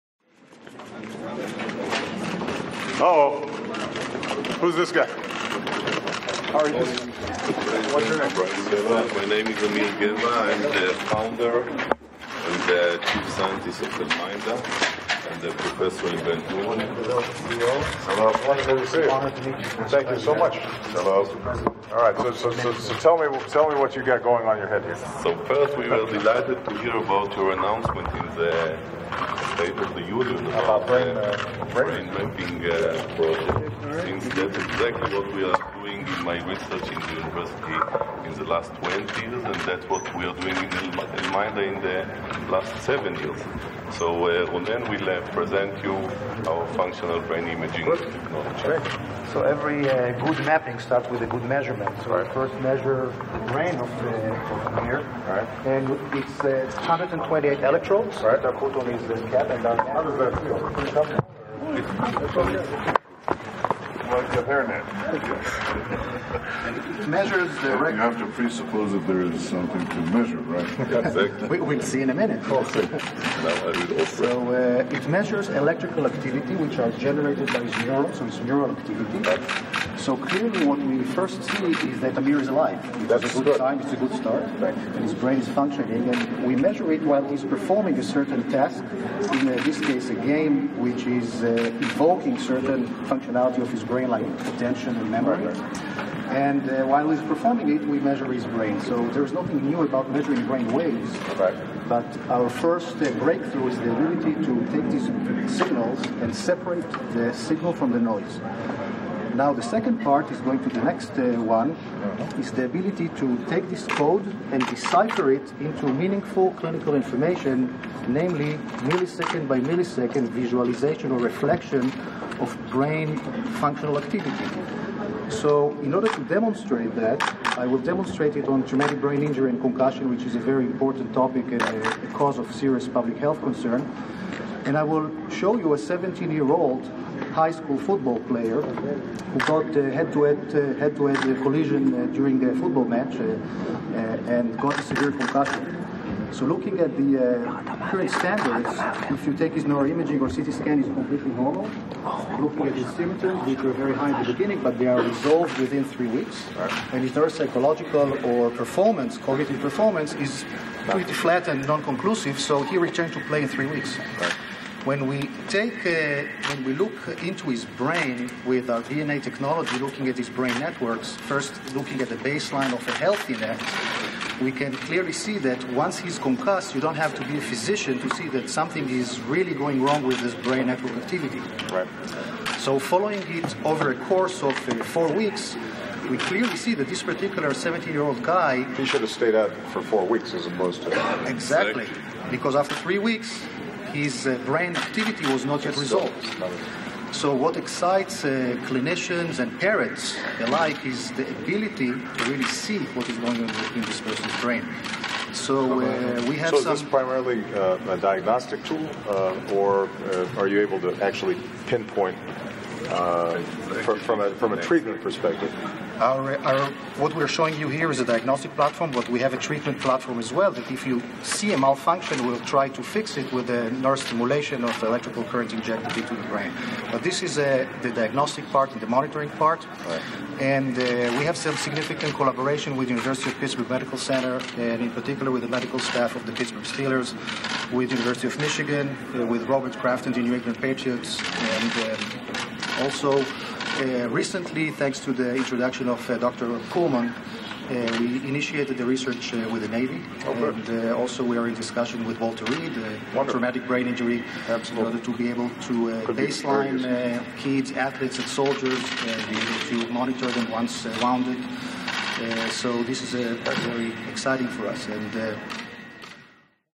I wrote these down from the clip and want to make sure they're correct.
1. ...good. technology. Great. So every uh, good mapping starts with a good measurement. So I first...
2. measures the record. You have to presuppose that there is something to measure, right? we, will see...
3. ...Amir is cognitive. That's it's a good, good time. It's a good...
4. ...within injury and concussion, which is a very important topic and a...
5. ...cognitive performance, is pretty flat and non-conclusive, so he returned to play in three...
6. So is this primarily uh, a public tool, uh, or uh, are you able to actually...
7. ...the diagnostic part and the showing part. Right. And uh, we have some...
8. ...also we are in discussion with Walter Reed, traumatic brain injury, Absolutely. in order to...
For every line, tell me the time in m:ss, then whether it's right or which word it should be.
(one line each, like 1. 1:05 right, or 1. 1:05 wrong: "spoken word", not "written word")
1. 0:47 right
2. 1:07 right
3. 1:22 wrong: "alive", not "cognitive"
4. 2:08 wrong: "brain", not "within"
5. 2:39 right
6. 3:26 wrong: "diagnostic", not "public"
7. 3:47 wrong: "monitoring", not "showing"
8. 4:10 right.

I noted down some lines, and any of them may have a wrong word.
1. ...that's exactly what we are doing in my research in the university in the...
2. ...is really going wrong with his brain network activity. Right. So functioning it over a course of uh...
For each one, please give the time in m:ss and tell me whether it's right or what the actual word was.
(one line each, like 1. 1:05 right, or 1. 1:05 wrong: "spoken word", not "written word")
1. 0:34 right
2. 2:58 wrong: "following", not "functioning".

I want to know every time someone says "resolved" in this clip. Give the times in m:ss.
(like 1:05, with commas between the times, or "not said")
2:35, 3:15.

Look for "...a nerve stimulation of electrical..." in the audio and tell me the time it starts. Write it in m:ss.
3:43.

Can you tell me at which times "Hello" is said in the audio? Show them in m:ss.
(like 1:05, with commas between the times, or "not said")
0:16, 0:20.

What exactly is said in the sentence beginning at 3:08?
He should have stayed out for four weeks as opposed to...